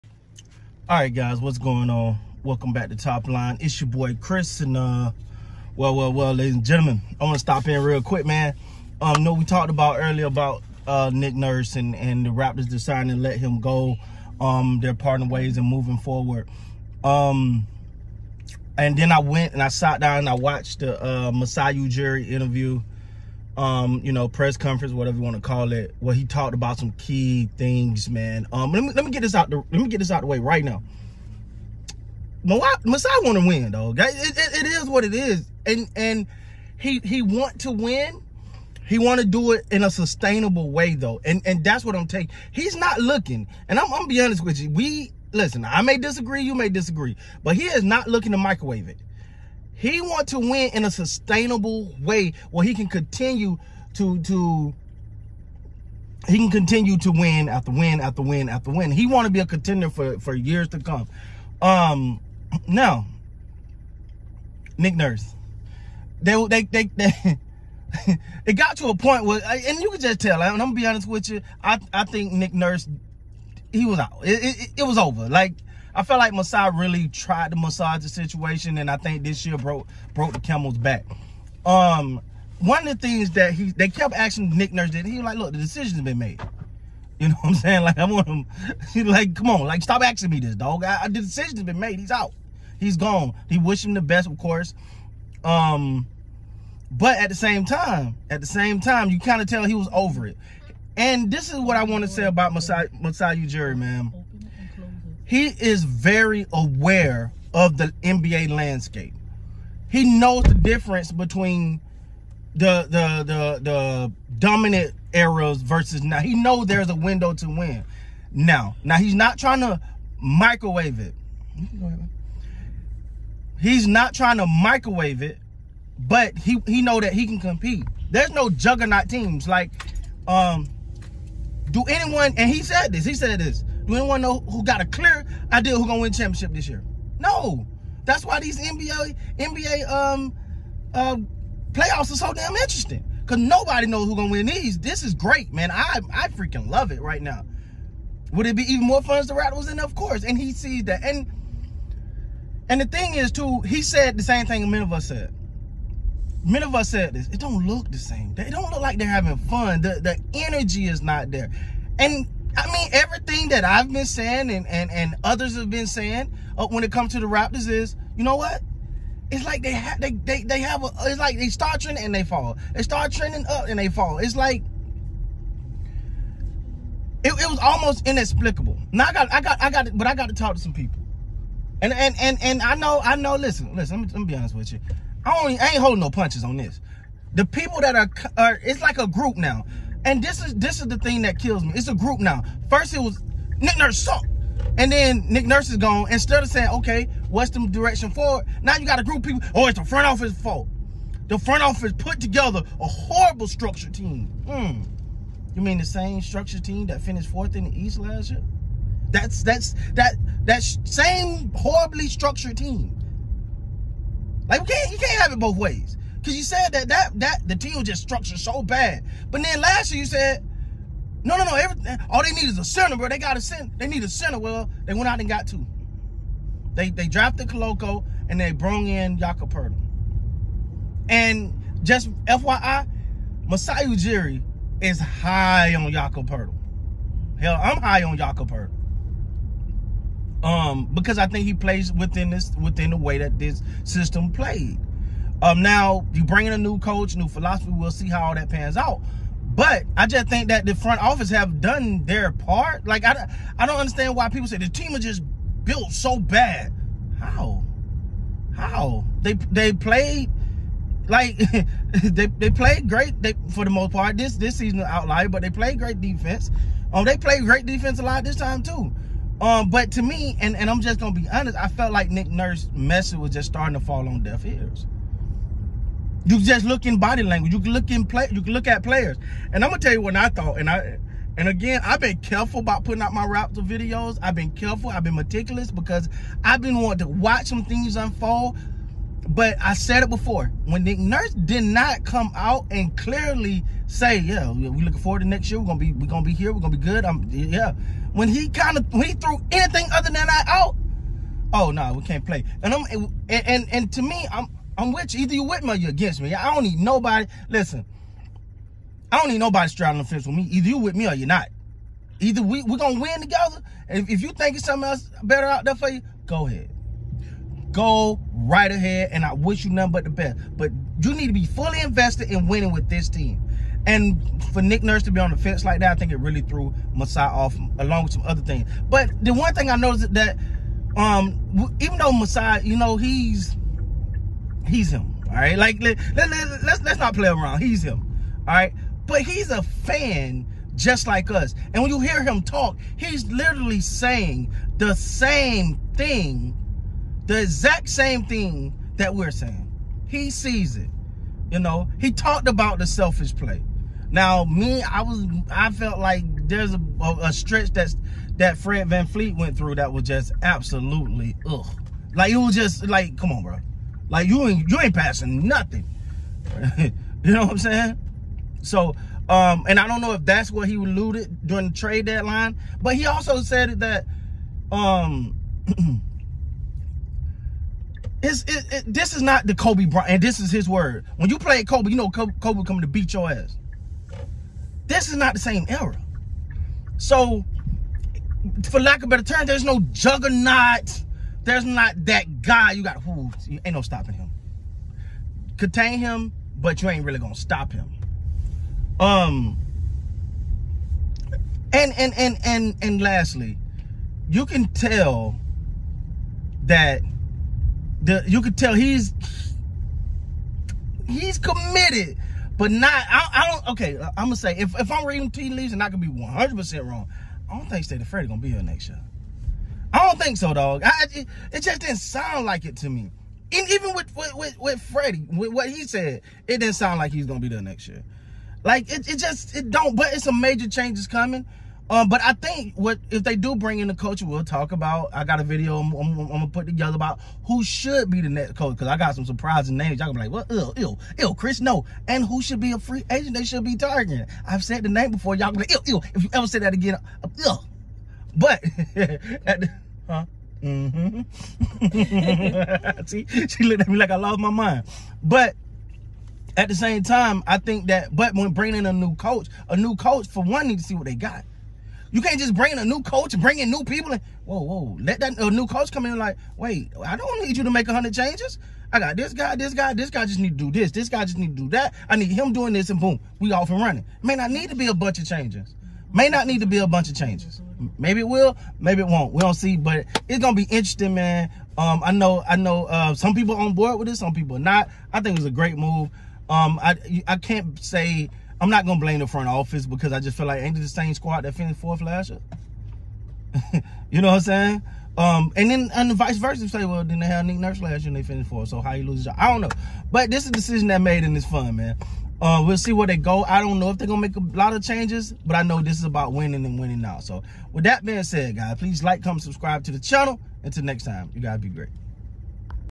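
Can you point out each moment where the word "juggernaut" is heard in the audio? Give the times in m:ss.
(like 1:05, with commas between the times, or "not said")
2:08, 6:29.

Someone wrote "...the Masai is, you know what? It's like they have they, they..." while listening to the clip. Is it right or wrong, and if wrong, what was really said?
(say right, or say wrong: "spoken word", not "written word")
wrong: "Raptors", not "Masai".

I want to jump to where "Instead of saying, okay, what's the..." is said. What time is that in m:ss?
3:16.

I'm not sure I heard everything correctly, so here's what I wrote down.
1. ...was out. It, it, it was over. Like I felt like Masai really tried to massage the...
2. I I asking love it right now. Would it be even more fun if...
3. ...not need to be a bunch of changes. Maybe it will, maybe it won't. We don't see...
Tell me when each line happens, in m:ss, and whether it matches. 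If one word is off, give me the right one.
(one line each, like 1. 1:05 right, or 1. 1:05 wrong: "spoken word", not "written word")
1. 1:13 right
2. 2:25 wrong: "freaking", not "asking"
3. 7:56 right.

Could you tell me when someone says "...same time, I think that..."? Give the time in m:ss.
7:36.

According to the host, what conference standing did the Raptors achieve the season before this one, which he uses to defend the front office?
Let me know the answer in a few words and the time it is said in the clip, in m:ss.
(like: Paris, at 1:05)
Fourth in the East, at 3:27.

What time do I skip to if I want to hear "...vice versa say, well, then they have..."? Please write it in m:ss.
8:16.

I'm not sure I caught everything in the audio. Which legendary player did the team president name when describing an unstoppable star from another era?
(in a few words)
Kobe Bryant.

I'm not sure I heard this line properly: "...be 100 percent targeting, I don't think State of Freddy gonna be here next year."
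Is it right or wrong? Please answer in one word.
wrong.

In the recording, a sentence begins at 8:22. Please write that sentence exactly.
Uh, we'll see where they go.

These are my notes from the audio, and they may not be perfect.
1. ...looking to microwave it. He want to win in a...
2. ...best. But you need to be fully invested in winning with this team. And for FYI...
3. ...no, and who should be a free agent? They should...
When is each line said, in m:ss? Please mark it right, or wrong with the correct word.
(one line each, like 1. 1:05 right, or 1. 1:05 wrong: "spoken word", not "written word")
1. 0:48 right
2. 5:20 wrong: "Nick", not "FYI"
3. 7:21 right.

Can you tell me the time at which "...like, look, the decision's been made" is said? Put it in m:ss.
1:25.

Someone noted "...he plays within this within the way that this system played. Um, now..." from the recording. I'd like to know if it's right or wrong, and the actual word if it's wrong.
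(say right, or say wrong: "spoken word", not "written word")
right.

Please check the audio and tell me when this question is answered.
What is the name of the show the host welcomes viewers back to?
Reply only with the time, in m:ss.
0:02.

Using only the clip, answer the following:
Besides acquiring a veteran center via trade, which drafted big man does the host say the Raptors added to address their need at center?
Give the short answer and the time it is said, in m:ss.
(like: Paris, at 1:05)
Koloko, at 3:47.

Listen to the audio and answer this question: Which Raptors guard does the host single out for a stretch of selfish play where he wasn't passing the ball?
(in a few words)
Fred VanVleet.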